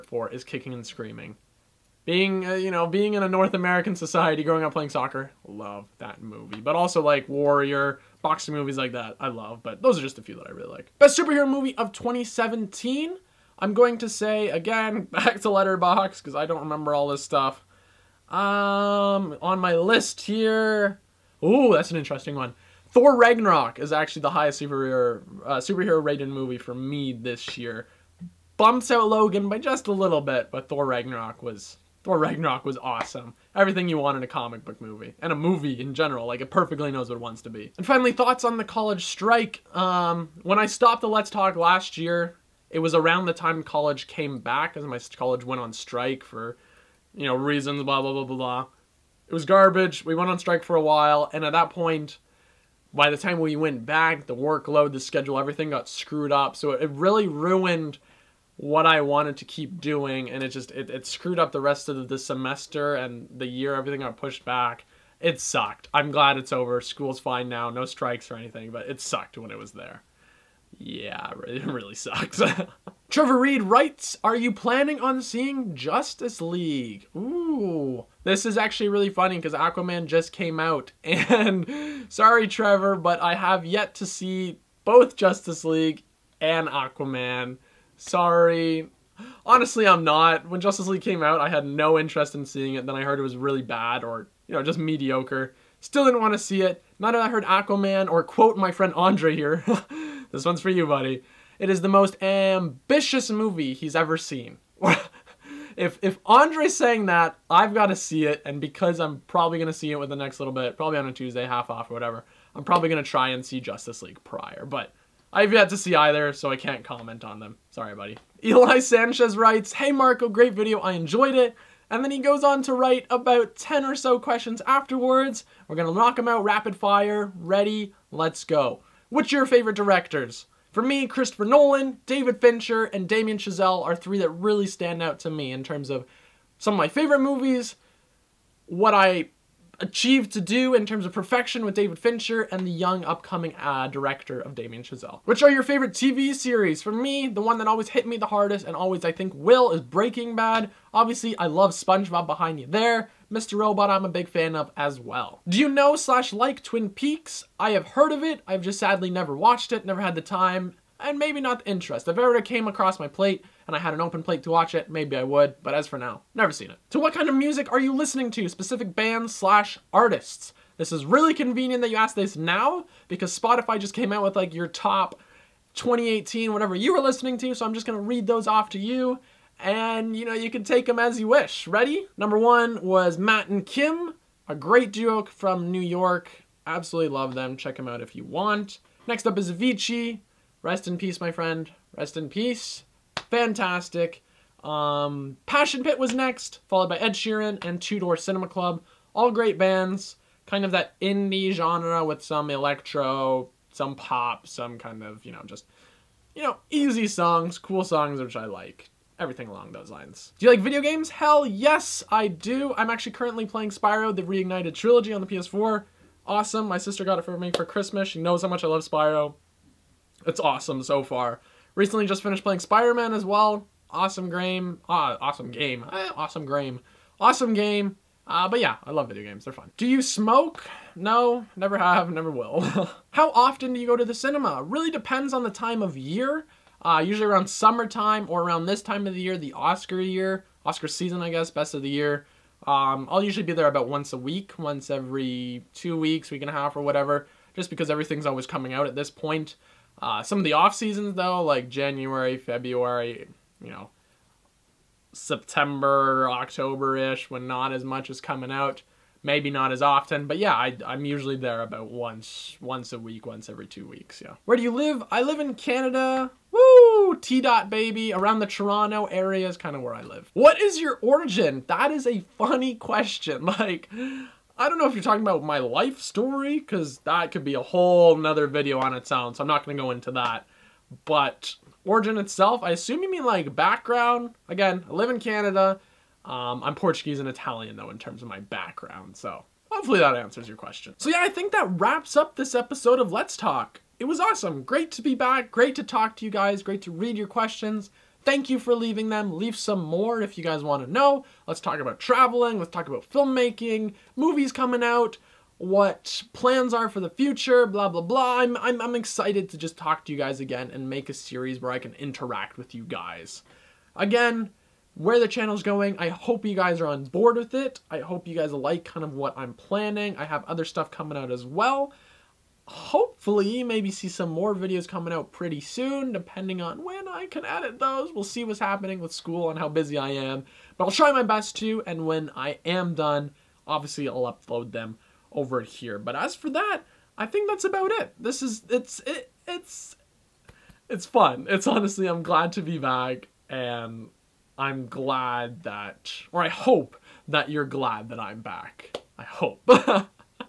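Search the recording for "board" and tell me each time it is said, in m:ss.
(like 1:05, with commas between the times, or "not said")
5:17.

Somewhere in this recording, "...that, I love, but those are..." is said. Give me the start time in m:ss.
0:08.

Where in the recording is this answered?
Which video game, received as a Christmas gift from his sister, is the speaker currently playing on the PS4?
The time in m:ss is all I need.
3:33.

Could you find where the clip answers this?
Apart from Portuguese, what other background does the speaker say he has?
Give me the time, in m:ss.
4:47.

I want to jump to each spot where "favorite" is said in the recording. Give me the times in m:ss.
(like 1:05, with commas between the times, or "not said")
2:09, 2:16, 2:25.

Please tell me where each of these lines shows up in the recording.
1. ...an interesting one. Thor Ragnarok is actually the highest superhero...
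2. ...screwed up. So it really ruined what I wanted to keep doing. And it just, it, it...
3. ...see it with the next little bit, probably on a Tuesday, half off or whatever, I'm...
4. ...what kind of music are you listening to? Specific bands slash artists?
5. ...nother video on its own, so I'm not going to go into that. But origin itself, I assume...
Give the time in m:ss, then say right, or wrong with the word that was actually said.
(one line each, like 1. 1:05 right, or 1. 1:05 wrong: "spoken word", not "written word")
1. 0:21 right
2. 0:55 right
3. 1:49 right
4. 2:46 right
5. 4:38 right.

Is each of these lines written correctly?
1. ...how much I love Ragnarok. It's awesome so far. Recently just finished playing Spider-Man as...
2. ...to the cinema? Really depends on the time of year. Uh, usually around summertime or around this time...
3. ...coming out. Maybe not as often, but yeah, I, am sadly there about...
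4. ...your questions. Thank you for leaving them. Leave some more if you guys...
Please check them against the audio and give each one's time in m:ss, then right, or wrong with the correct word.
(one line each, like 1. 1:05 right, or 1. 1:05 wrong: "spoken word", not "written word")
1. 3:38 wrong: "Spyro", not "Ragnarok"
2. 3:53 right
3. 4:18 wrong: "usually", not "sadly"
4. 4:57 right.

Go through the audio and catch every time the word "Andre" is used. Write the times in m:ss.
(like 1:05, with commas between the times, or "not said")
1:38, 1:46.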